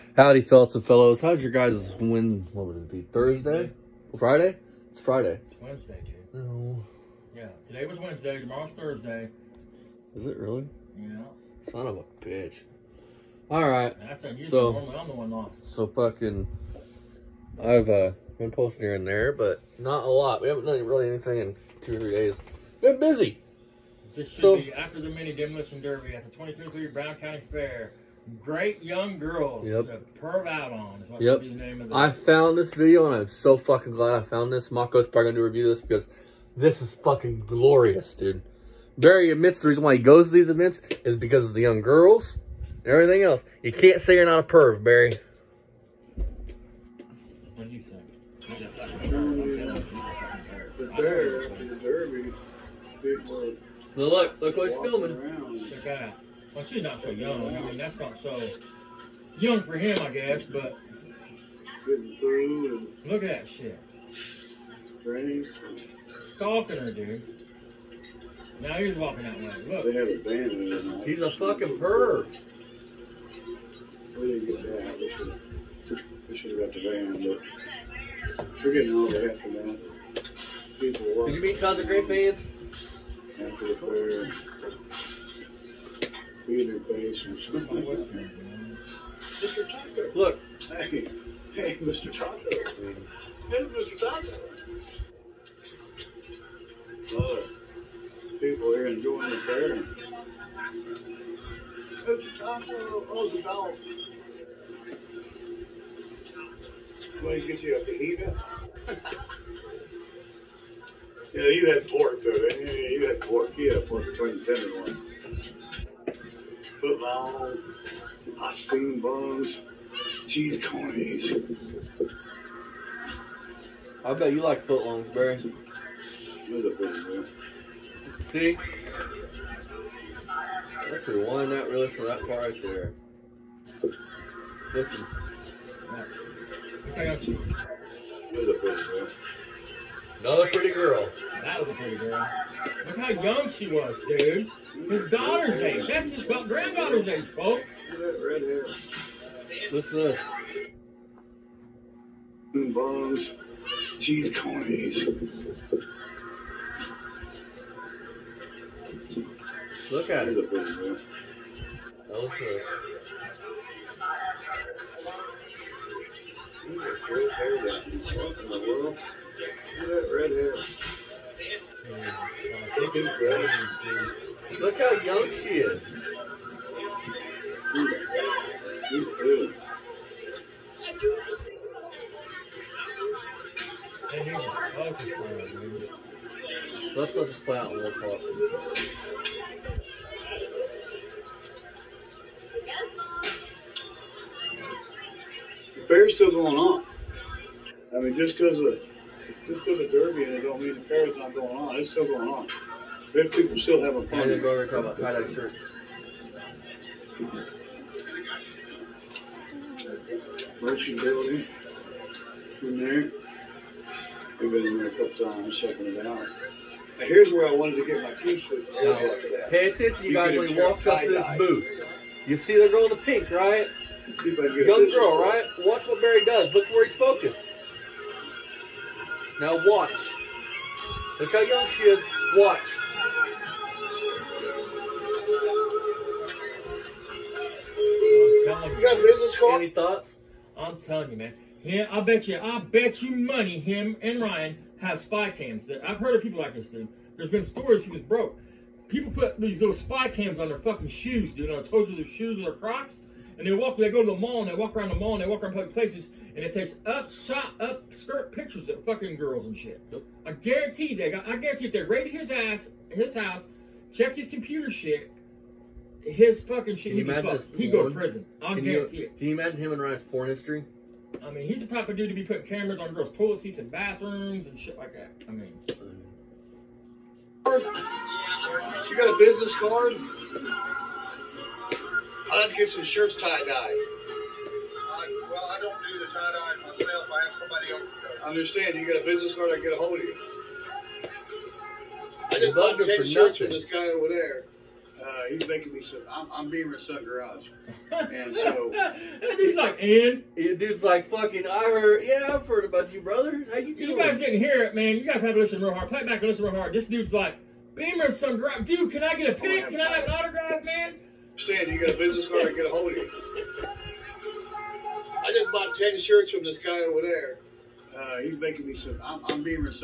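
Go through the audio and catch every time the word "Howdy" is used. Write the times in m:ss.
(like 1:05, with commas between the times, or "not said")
0:00.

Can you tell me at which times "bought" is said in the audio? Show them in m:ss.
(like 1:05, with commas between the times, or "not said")
4:52, 5:15.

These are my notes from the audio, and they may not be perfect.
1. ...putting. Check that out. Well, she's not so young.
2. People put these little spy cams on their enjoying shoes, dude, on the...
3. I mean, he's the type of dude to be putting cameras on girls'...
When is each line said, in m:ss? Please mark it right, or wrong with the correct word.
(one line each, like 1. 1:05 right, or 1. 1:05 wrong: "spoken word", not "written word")
1. 0:54 wrong: "filming", not "putting"
2. 4:08 wrong: "fucking", not "enjoying"
3. 4:31 right.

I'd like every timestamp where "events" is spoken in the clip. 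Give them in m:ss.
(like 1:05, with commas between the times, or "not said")
0:40.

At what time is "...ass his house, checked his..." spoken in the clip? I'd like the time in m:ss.
4:22.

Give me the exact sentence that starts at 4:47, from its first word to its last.
I have somebody else that does.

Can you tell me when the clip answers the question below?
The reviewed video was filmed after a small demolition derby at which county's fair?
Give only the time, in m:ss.
0:26.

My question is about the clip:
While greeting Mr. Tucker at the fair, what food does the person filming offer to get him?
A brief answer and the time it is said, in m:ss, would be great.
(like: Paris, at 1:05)
fajita, at 1:47.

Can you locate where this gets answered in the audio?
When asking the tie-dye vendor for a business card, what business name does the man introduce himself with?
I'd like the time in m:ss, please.
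4:56.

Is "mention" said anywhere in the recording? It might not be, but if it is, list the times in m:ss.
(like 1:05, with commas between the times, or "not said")
not said.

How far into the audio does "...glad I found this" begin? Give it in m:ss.
0:33.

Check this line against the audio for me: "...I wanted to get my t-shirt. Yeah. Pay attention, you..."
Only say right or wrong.
right.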